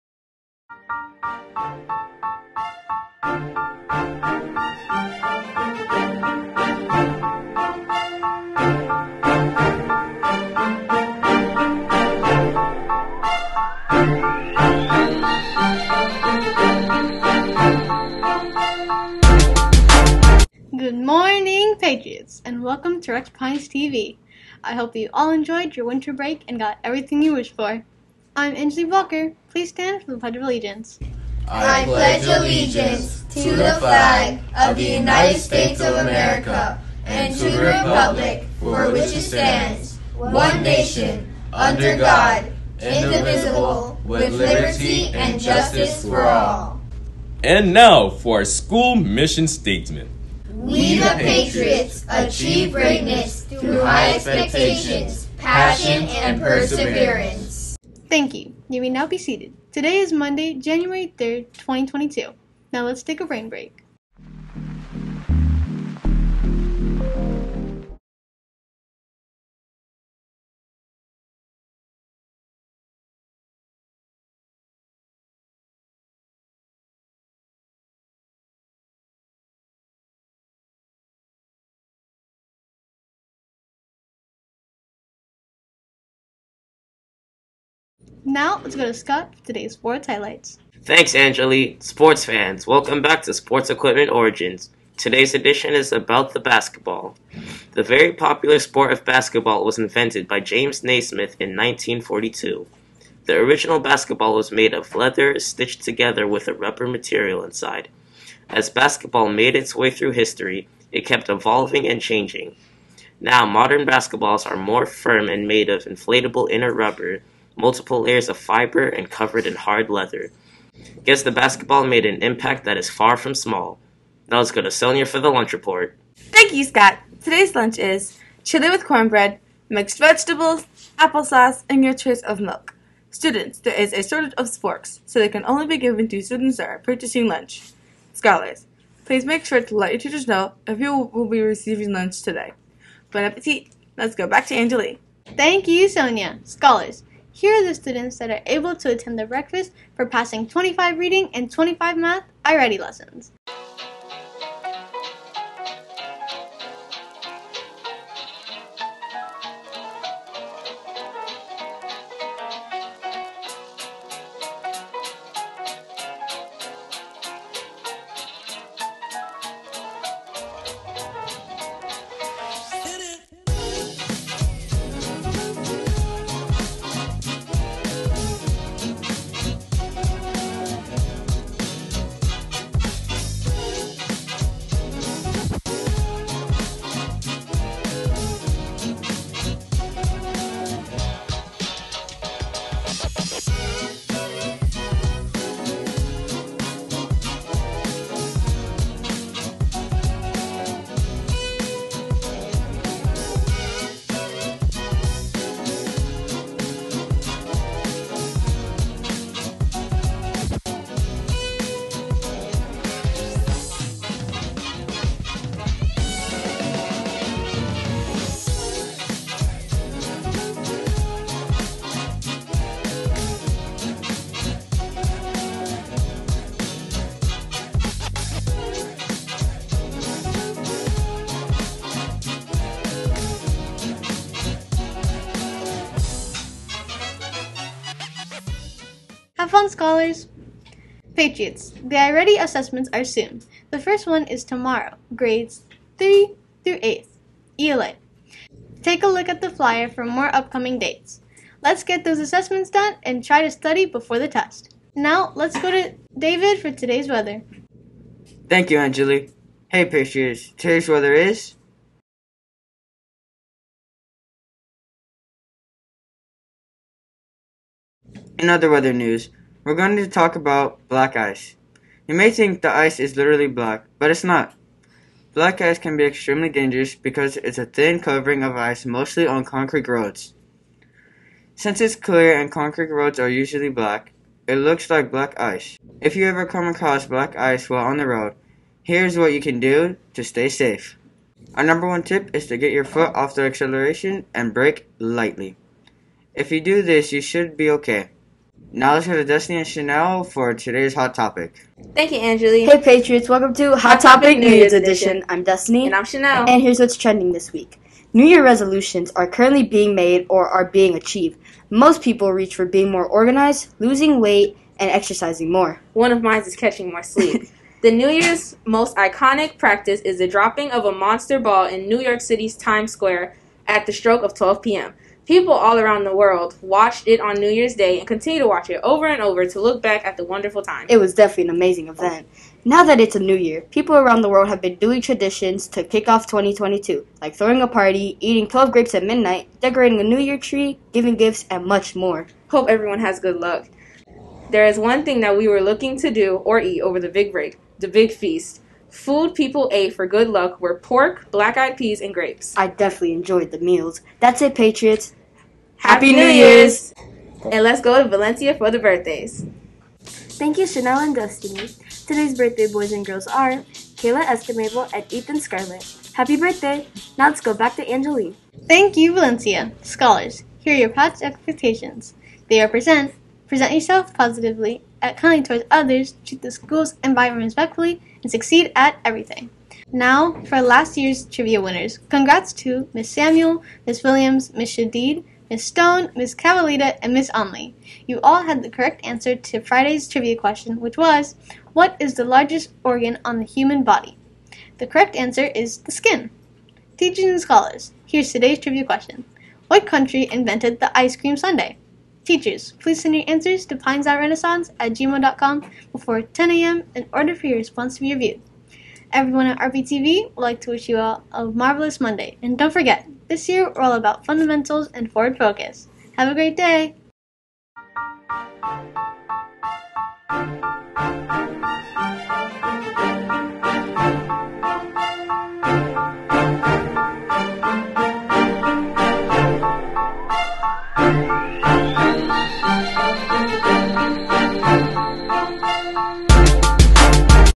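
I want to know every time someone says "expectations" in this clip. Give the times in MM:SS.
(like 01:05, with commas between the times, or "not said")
00:54, 06:11.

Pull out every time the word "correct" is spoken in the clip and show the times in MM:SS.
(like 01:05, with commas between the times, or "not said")
06:28, 06:34.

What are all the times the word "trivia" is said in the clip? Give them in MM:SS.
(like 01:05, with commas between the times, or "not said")
06:21, 06:30, 06:38.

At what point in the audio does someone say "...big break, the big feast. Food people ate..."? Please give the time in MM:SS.
05:47.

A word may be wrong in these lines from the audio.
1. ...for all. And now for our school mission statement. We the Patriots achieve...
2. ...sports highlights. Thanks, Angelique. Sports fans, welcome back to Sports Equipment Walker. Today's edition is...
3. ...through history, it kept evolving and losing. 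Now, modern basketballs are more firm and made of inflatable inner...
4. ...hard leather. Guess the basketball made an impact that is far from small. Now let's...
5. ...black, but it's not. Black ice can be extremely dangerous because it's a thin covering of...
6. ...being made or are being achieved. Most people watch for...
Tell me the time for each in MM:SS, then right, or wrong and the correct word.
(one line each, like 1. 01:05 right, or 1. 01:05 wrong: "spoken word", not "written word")
1. 00:46 right
2. 01:29 wrong: "Origins", not "Walker"
3. 01:49 wrong: "changing", not "losing"
4. 01:59 right
5. 04:33 right
6. 05:09 wrong: "reach", not "watch".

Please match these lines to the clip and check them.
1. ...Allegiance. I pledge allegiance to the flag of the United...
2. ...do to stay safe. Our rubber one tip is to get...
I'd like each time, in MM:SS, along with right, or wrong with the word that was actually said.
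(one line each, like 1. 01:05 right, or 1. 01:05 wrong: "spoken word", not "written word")
1. 00:30 right
2. 04:49 wrong: "number", not "rubber".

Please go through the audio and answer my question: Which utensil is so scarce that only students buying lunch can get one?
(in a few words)
Forks.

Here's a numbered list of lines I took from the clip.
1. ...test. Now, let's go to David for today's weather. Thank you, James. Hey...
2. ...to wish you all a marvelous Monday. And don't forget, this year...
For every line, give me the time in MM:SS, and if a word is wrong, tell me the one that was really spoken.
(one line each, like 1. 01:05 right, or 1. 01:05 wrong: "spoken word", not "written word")
1. 04:14 wrong: "Angelique", not "James"
2. 06:50 right.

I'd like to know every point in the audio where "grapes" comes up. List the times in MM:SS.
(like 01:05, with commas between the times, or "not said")
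05:38, 05:52.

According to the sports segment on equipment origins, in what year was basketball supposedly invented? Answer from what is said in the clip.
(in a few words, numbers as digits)
1942.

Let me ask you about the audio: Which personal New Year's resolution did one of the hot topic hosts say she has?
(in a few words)
Catching more sleep.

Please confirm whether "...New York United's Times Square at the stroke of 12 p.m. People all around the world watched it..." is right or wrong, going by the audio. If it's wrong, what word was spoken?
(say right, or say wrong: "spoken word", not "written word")
wrong: "City", not "United".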